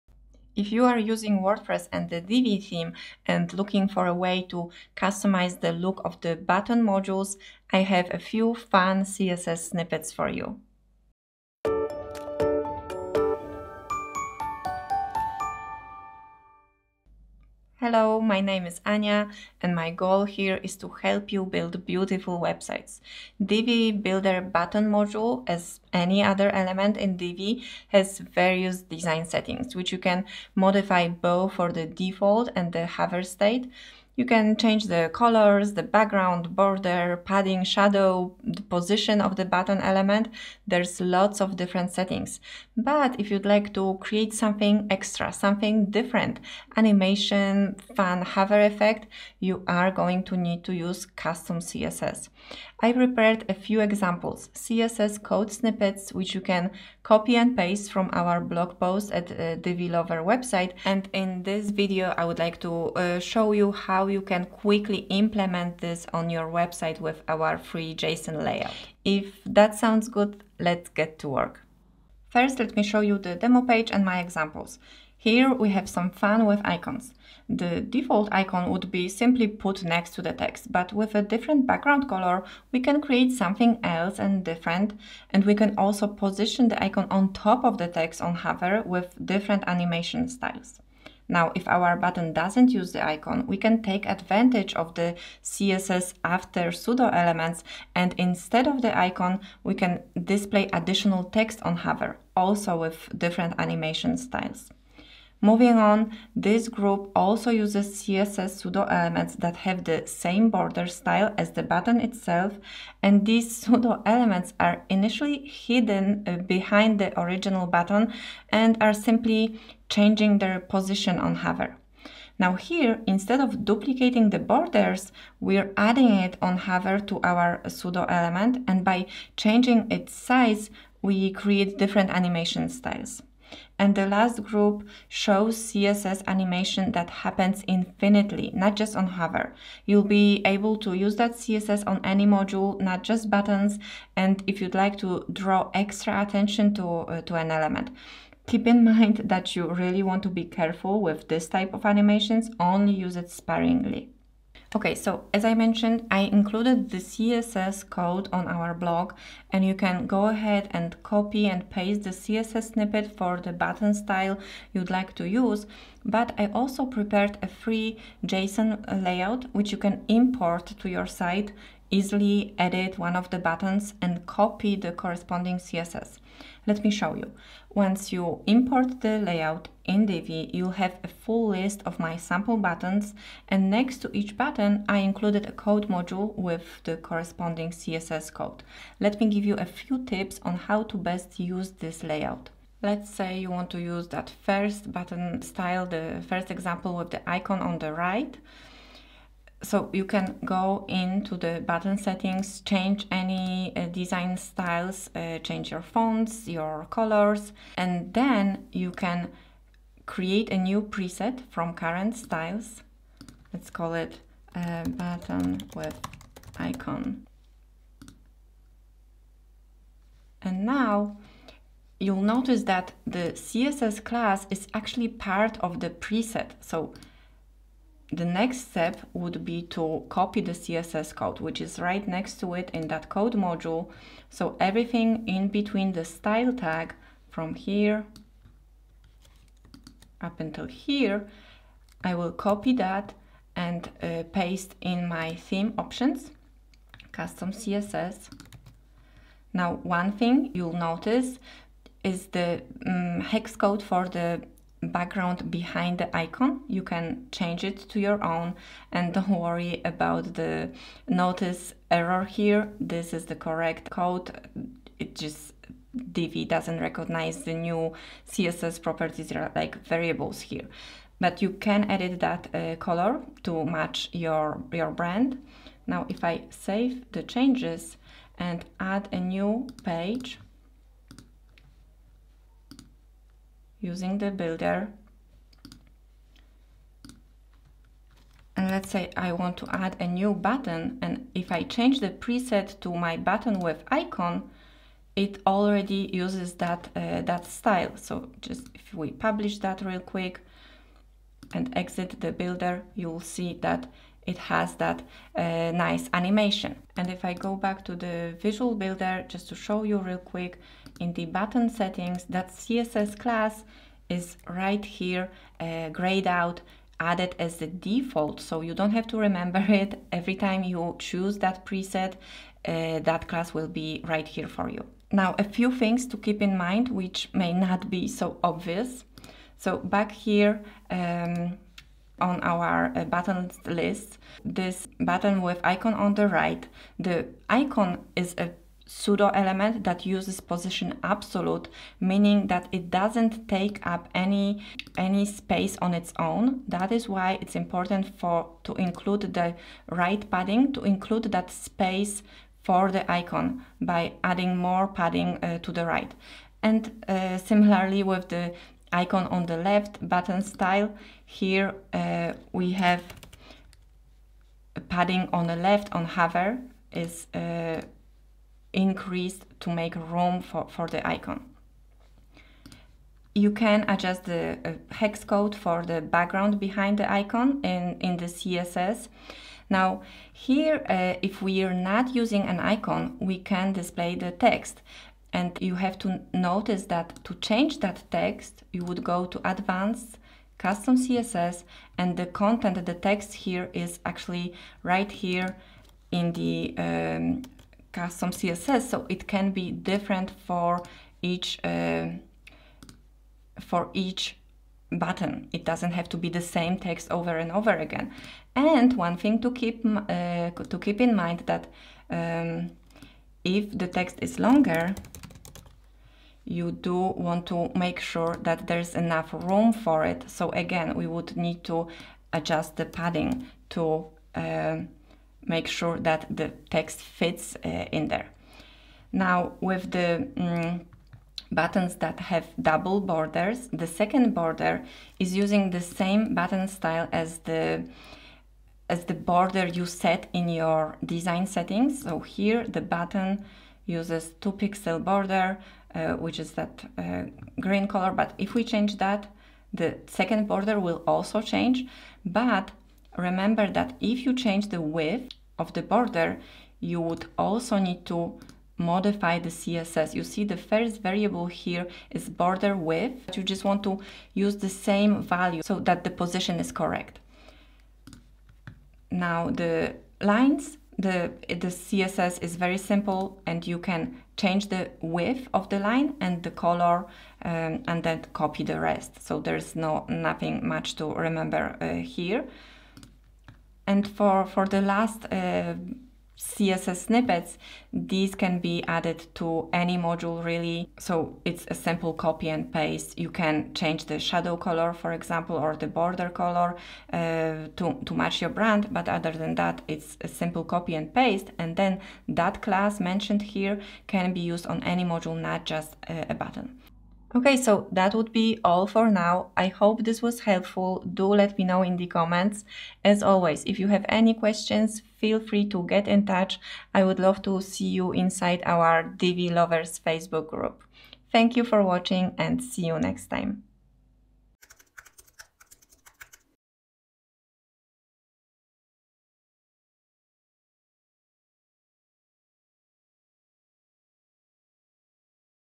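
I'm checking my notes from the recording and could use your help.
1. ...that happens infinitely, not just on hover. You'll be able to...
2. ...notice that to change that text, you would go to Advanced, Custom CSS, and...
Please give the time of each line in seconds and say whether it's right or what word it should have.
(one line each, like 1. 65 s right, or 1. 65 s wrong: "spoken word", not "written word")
1. 136 s right
2. 386 s right.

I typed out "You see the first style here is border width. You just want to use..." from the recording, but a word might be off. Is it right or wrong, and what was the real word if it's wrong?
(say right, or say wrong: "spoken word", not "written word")
wrong: "variable", not "style".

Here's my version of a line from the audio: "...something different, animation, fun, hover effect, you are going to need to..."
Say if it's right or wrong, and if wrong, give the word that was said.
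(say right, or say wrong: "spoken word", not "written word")
right.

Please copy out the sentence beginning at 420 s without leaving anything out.
So again, we would need to adjust the padding to uh, make sure that the text fits uh, in there.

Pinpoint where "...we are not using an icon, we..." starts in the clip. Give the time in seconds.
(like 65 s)
381 s.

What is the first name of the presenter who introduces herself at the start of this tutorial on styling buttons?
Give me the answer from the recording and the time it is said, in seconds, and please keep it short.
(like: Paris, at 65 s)
Ania, at 18 s.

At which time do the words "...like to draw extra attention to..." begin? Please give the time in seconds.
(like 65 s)
144 s.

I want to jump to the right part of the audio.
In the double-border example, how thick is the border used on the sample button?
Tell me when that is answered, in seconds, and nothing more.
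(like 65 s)
444 s.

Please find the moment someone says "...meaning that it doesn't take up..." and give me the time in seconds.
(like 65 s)
341 s.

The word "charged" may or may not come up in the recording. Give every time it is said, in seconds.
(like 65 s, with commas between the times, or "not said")
not said.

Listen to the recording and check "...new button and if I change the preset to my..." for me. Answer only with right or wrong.
right.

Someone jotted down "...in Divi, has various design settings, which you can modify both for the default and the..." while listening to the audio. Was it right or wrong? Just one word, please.
right.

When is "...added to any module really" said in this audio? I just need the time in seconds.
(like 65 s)
488 s.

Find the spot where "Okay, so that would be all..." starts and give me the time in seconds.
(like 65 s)
507 s.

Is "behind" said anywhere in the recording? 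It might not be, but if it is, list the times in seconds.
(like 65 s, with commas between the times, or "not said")
116 s, 255 s, 376 s.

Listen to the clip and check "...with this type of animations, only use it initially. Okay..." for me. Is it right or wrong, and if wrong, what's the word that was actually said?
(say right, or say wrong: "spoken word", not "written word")
wrong: "sparingly", not "initially".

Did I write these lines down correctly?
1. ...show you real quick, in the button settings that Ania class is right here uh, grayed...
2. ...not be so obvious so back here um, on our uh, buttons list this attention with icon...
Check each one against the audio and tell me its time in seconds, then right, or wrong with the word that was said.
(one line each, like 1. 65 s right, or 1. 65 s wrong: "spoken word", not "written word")
1. 309 s wrong: "CSS", not "Ania"
2. 327 s wrong: "button", not "attention".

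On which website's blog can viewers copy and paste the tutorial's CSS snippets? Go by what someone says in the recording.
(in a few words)
Divi Lover.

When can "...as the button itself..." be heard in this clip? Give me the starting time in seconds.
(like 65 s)
111 s.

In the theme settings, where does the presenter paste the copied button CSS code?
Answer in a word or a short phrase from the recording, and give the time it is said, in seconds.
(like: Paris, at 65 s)
theme options, custom CSS, at 245 s.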